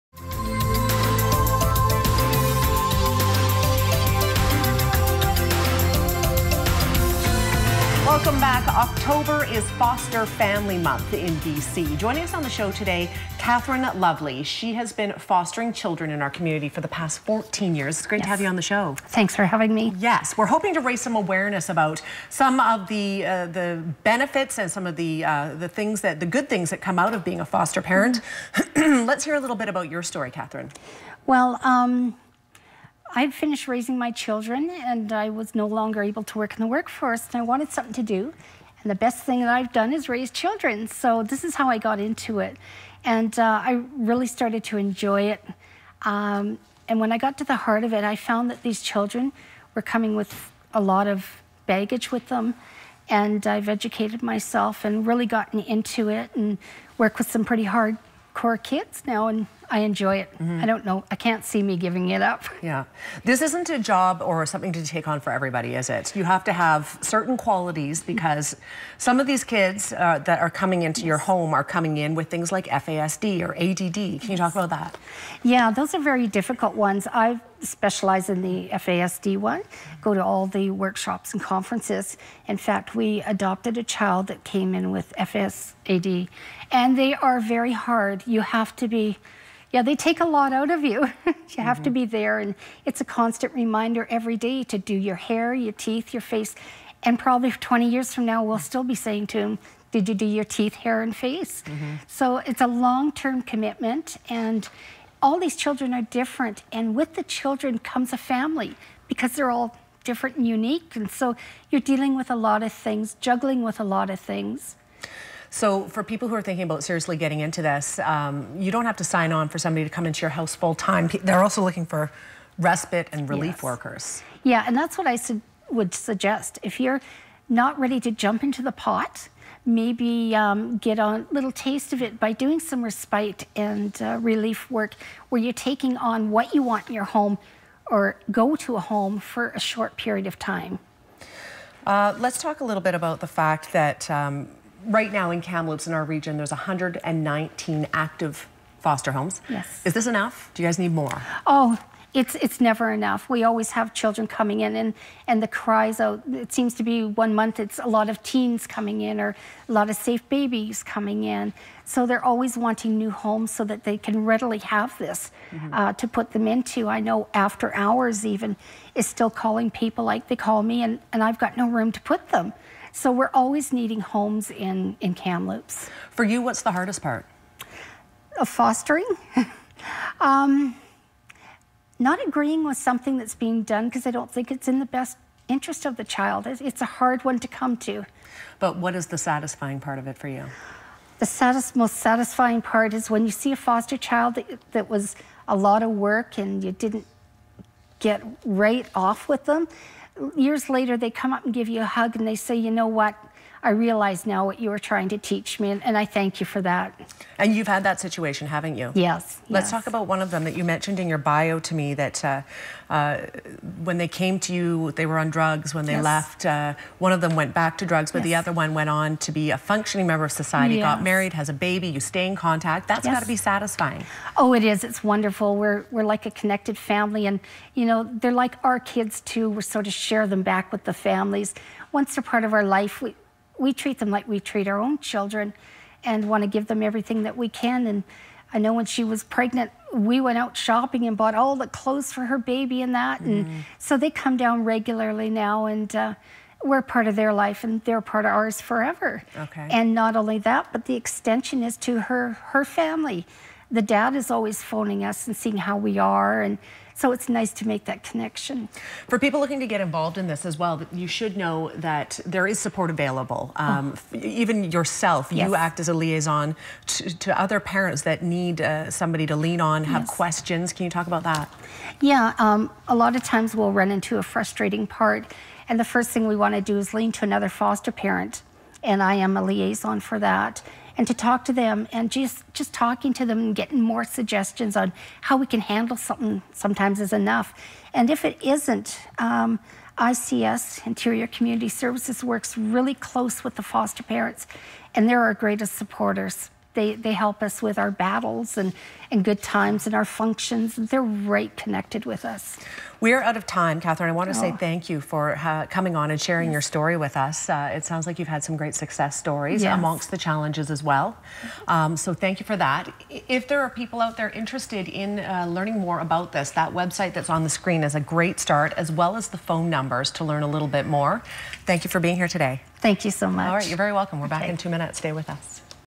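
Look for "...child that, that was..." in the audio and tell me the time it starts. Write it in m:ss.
3:13.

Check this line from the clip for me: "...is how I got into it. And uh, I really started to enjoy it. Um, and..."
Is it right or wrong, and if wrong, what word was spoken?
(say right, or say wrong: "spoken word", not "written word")
right.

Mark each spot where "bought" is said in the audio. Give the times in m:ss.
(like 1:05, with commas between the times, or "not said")
4:01.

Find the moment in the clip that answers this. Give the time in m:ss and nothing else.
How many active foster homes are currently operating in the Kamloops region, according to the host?
2:26.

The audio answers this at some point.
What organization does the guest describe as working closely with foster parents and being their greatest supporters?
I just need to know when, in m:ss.
4:50.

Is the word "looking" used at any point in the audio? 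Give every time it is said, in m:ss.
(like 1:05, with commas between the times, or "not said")
2:01, 4:19.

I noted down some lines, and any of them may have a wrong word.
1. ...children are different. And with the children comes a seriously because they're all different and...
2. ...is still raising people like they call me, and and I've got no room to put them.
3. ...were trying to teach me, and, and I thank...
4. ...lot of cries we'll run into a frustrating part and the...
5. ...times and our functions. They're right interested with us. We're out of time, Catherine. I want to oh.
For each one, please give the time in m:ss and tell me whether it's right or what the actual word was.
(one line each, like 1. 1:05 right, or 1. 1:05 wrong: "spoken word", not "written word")
1. 1:45 wrong: "family", not "seriously"
2. 2:48 wrong: "calling", not "raising"
3. 3:24 right
4. 4:32 wrong: "times", not "cries"
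5. 4:59 wrong: "connected", not "interested".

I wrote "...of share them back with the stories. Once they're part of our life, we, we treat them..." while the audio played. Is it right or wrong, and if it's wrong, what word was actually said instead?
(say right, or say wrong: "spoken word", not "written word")
wrong: "families", not "stories".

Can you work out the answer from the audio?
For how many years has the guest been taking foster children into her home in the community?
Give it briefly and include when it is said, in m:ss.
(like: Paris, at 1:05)
14, at 0:17.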